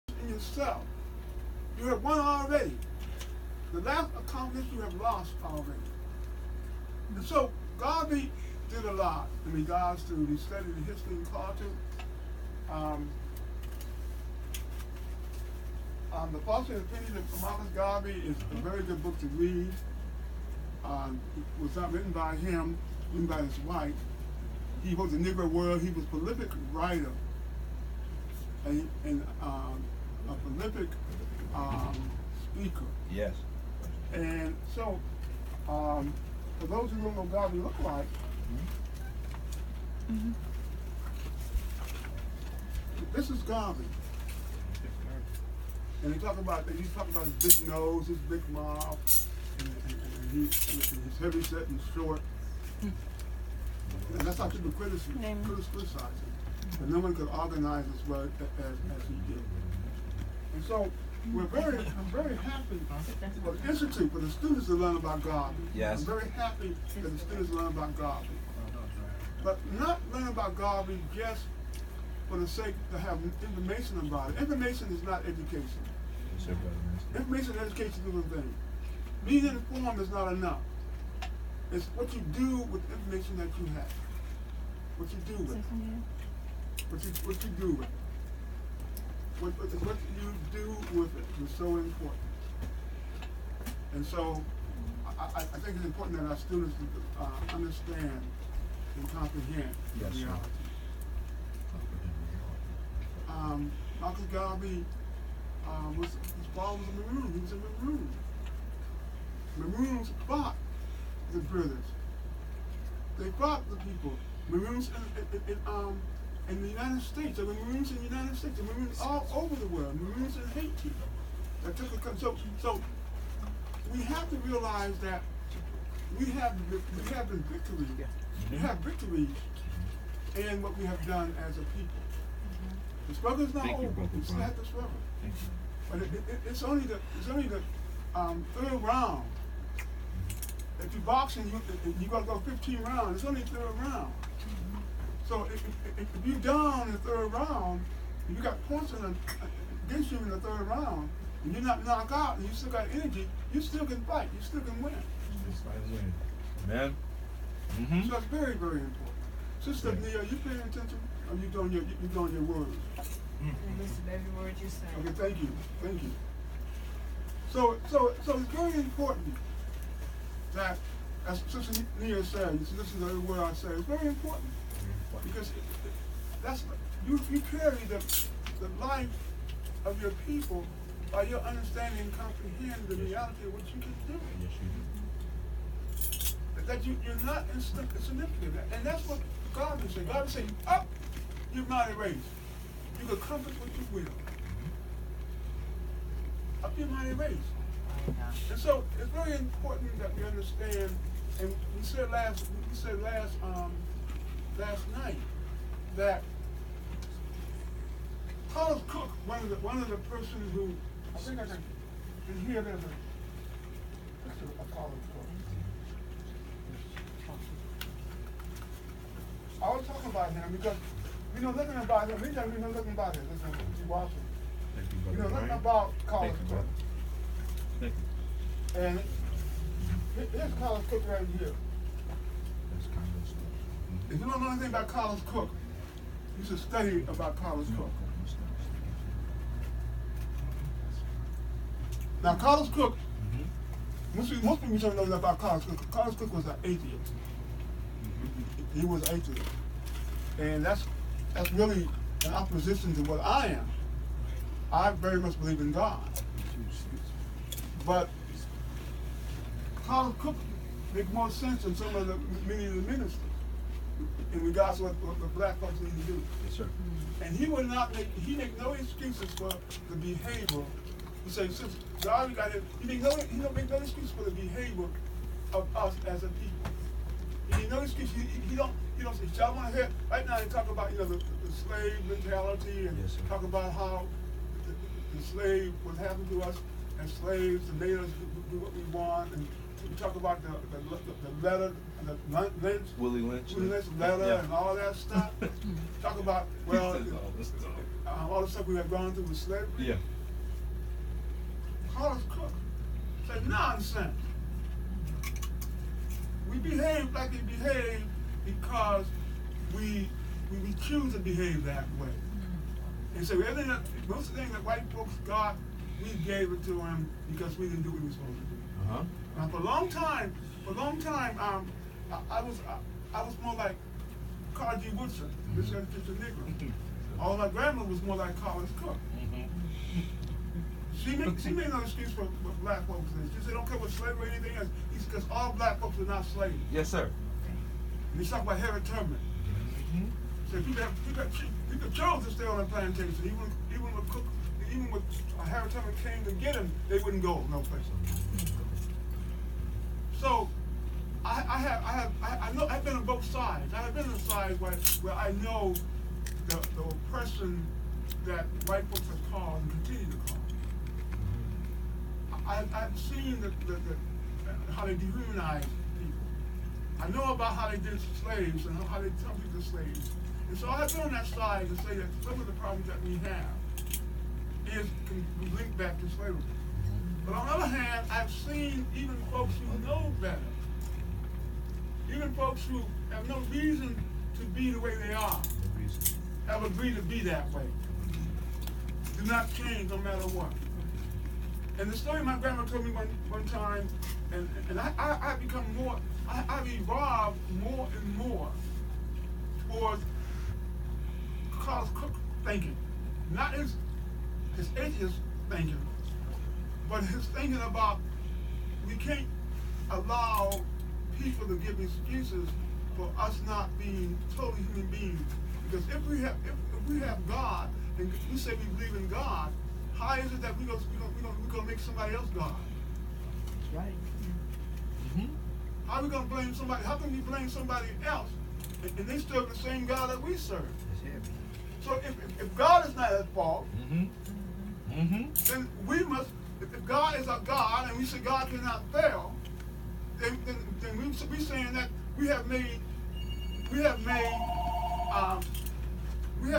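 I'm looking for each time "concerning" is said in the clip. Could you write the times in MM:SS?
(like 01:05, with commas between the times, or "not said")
not said.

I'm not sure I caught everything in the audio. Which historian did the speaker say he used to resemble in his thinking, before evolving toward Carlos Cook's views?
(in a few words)
Carter G. Woodson.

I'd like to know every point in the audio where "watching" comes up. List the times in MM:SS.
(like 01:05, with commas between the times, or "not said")
03:43.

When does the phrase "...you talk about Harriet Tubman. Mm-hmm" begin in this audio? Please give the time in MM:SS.
05:38.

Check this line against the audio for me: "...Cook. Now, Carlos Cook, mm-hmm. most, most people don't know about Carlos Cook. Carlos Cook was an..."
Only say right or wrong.
right.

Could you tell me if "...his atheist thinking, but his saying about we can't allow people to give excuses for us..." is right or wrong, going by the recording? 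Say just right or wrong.
wrong.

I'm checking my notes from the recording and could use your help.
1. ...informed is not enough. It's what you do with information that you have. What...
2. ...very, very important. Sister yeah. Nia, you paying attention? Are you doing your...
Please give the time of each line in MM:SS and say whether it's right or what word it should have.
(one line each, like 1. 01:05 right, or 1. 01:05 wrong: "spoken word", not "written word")
1. 01:19 right
2. 02:38 right.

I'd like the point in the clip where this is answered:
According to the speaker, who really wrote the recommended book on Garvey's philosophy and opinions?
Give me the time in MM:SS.
00:23.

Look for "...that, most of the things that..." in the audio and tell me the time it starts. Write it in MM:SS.
05:13.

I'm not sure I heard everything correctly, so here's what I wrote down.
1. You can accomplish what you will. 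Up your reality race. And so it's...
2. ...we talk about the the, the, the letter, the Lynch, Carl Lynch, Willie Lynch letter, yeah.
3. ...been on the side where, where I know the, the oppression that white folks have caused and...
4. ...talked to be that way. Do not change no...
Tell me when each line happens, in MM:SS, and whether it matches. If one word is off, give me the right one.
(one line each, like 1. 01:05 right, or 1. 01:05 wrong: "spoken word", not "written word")
1. 03:12 wrong: "mighty", not "reality"
2. 04:49 wrong: "Willie", not "Carl"
3. 05:53 right
4. 06:26 wrong: "agreed", not "talked".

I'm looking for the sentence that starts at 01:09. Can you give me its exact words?
But not learn about Garvey just for the sake to have information about it.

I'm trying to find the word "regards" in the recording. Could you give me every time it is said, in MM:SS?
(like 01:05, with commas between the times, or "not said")
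00:09, 04:24.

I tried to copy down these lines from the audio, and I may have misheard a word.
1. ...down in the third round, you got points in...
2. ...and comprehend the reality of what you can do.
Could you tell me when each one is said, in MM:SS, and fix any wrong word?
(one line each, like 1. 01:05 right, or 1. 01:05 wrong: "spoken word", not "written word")
1. 02:26 right
2. 03:02 right.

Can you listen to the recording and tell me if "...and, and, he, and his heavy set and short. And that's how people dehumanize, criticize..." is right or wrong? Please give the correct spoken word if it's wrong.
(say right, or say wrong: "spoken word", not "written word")
wrong: "criticize", not "dehumanize".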